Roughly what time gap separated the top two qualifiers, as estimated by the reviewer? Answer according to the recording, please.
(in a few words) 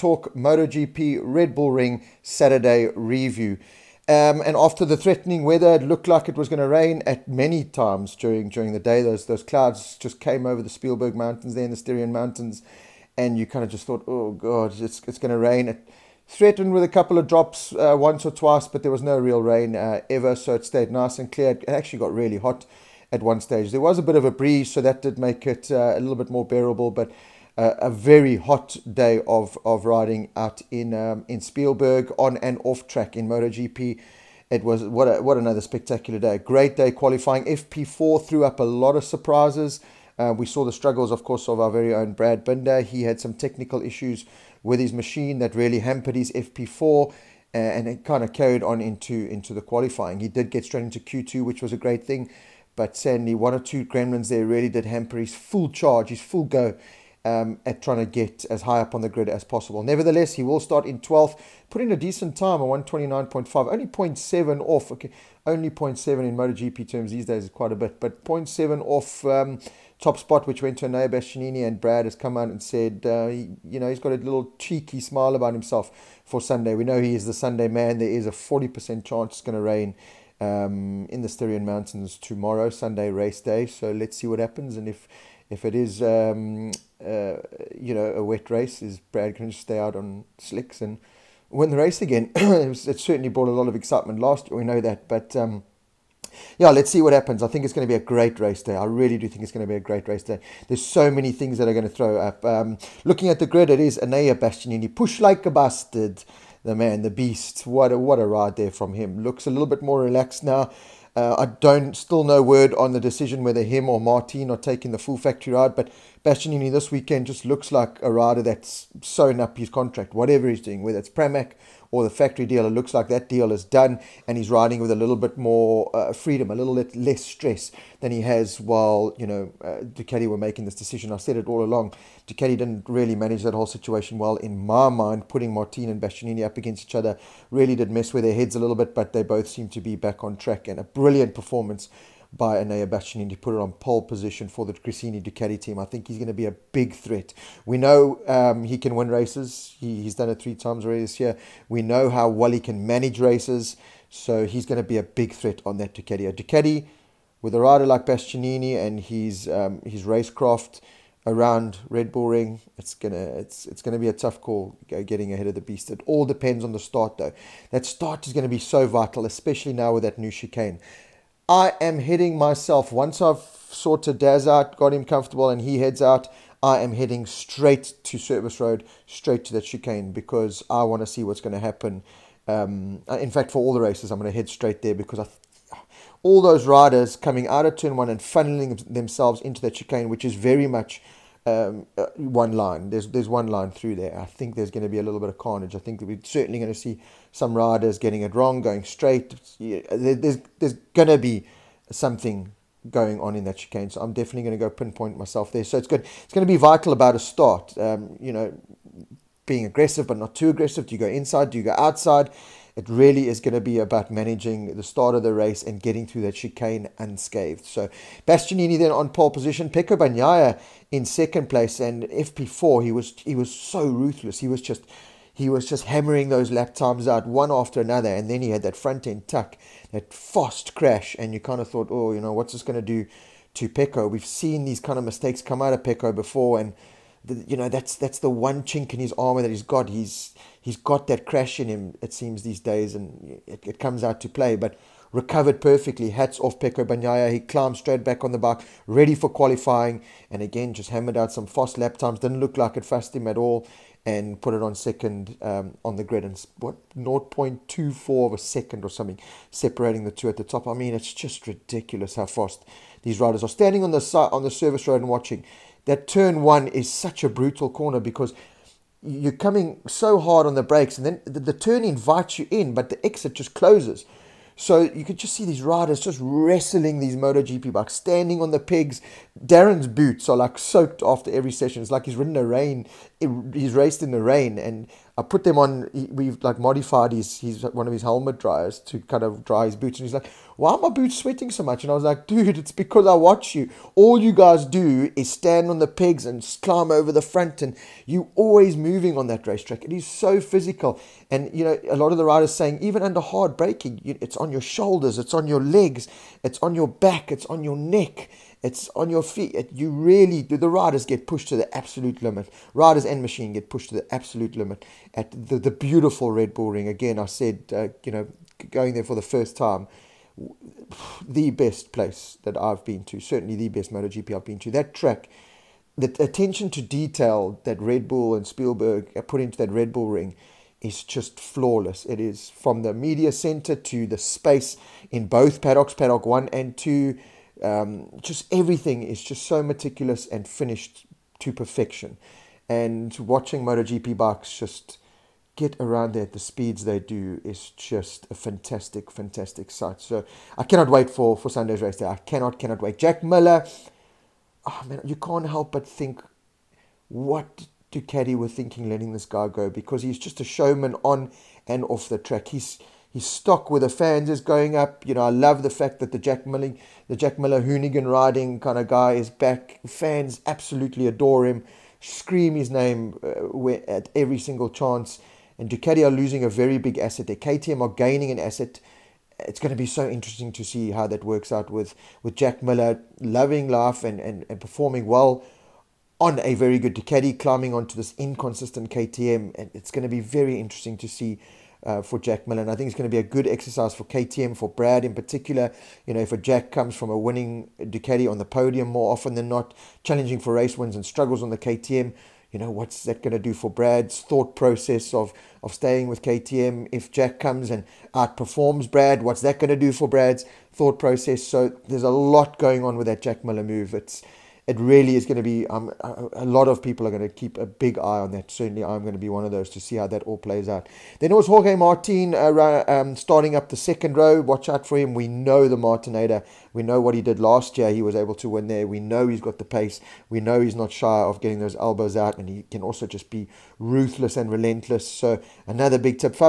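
0.24 seconds.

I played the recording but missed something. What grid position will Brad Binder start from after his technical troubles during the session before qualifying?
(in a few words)
12th.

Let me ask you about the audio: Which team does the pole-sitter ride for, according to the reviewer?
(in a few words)
Gresini Ducati.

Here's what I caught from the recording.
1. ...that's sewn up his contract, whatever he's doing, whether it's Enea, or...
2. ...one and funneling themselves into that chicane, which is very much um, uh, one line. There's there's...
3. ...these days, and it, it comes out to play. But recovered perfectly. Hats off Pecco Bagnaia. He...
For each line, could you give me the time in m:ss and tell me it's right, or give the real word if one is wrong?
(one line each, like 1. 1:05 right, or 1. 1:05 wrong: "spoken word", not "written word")
1. 1:58 wrong: "Pramac", not "Enea"
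2. 3:07 right
3. 4:02 right.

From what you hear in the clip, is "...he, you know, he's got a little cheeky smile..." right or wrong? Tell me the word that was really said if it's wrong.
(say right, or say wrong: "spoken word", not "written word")
right.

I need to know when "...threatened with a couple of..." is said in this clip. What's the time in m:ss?
0:16.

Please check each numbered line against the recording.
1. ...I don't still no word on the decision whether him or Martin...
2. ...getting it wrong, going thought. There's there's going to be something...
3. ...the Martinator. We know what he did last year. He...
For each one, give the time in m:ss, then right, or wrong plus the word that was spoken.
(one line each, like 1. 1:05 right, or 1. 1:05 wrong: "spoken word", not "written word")
1. 1:51 right
2. 3:17 wrong: "straight", not "thought"
3. 7:05 right.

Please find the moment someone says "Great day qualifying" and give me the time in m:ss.
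0:36.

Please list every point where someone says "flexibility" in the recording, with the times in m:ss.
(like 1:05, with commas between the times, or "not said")
not said.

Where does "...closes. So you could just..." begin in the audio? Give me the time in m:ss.
4:33.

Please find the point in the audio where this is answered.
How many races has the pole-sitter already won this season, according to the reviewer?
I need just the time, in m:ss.
2:30.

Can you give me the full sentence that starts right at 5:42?
And watching MotoGP bikes just get around there at the speeds they do is just a fantastic, fantastic sight.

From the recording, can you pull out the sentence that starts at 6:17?
Their KTM are gaining an asset.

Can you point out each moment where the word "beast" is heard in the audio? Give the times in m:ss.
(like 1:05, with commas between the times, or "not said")
1:47, 2:45.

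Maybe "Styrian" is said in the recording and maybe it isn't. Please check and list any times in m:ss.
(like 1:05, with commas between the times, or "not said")
0:11, 1:21.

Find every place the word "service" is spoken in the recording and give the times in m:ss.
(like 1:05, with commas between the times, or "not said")
2:58, 4:24.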